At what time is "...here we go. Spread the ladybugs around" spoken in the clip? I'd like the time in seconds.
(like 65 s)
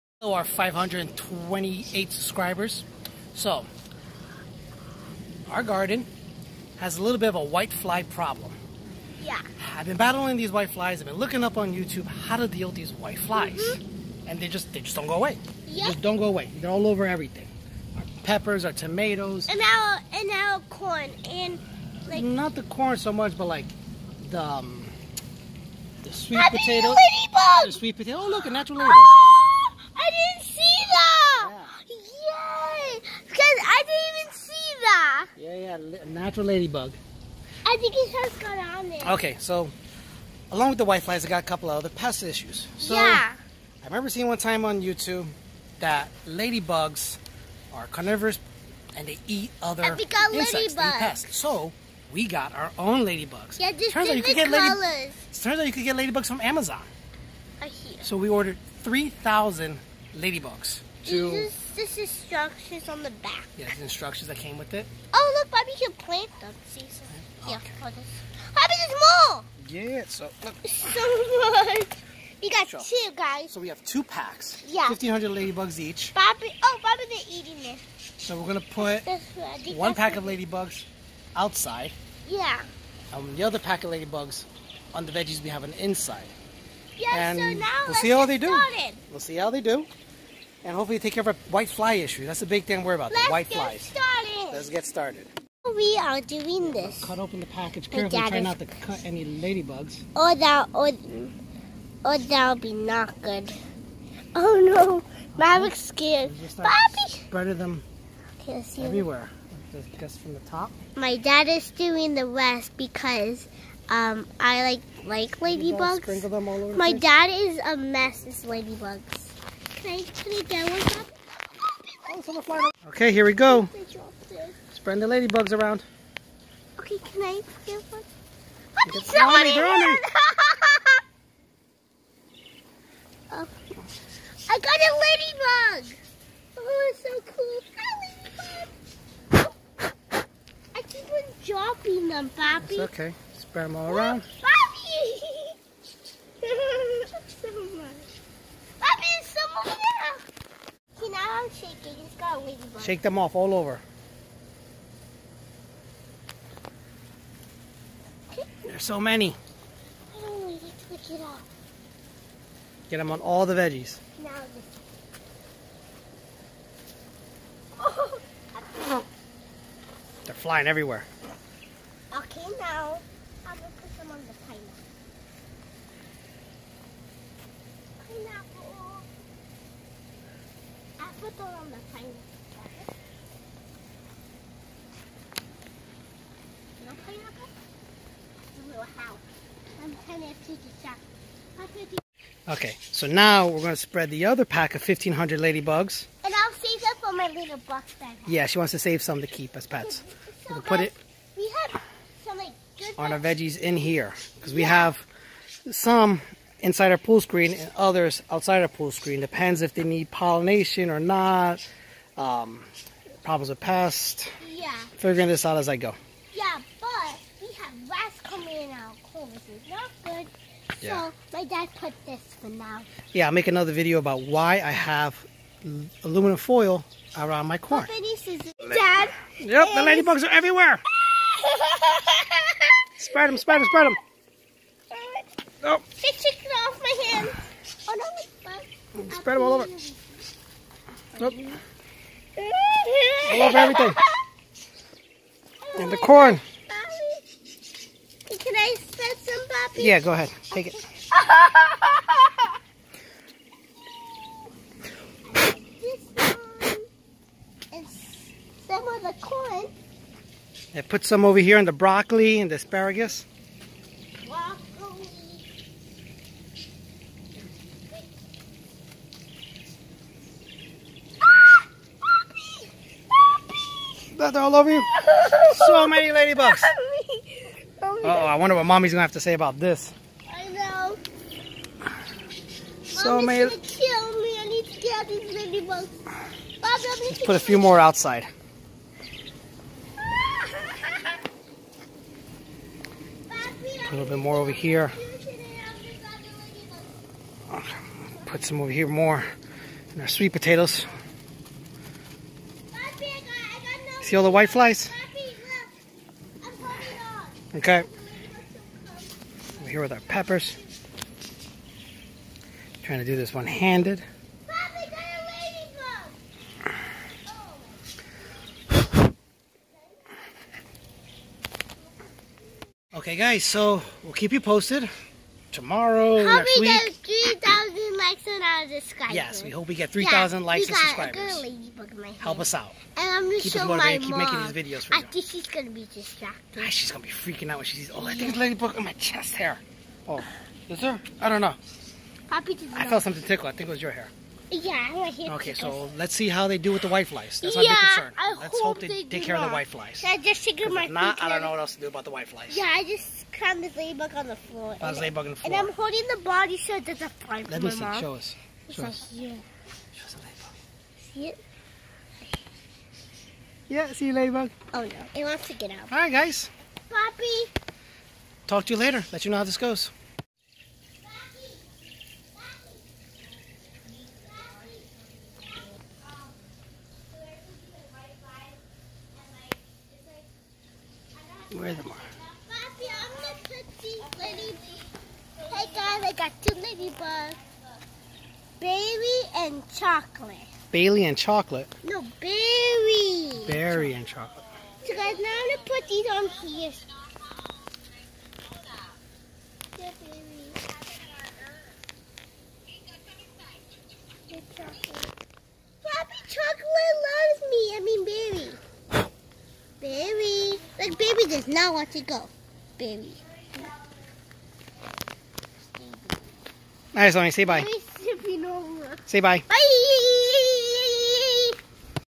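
123 s.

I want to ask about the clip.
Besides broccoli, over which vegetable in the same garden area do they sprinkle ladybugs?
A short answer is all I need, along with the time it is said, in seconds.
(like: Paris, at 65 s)
Asparagus, at 262 s.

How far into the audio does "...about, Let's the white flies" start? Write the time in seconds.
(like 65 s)
92 s.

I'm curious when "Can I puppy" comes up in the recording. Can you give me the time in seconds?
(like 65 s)
248 s.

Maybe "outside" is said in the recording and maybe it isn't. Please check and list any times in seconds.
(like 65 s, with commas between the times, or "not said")
81 s, 208 s, 287 s.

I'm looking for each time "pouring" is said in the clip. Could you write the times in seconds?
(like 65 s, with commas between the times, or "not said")
not said.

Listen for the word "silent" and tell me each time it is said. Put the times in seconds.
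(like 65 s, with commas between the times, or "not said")
not said.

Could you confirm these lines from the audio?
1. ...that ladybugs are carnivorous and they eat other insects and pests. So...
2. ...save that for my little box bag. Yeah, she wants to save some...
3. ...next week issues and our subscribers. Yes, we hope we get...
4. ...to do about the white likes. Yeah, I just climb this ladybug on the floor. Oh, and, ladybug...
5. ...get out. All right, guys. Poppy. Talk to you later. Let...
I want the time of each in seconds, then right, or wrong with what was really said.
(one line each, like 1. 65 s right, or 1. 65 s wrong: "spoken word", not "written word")
1. 45 s right
2. 196 s right
3. 326 s wrong: "likes", not "issues"
4. 351 s wrong: "flies", not "likes"
5. 365 s right.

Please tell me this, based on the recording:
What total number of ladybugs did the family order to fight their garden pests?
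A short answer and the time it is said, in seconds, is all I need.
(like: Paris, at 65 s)
3,000, at 58 s.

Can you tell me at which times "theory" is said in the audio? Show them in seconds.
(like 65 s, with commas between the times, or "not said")
not said.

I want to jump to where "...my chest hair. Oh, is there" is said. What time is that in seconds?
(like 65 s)
338 s.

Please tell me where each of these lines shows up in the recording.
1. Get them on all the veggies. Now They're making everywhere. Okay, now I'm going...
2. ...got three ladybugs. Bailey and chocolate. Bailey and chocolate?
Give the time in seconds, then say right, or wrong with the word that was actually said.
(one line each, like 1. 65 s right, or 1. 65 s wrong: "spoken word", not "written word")
1. 162 s wrong: "flying", not "making"
2. 386 s wrong: "two", not "three".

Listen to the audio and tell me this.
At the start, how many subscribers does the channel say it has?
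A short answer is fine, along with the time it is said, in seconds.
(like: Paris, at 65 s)
528, at 0 s.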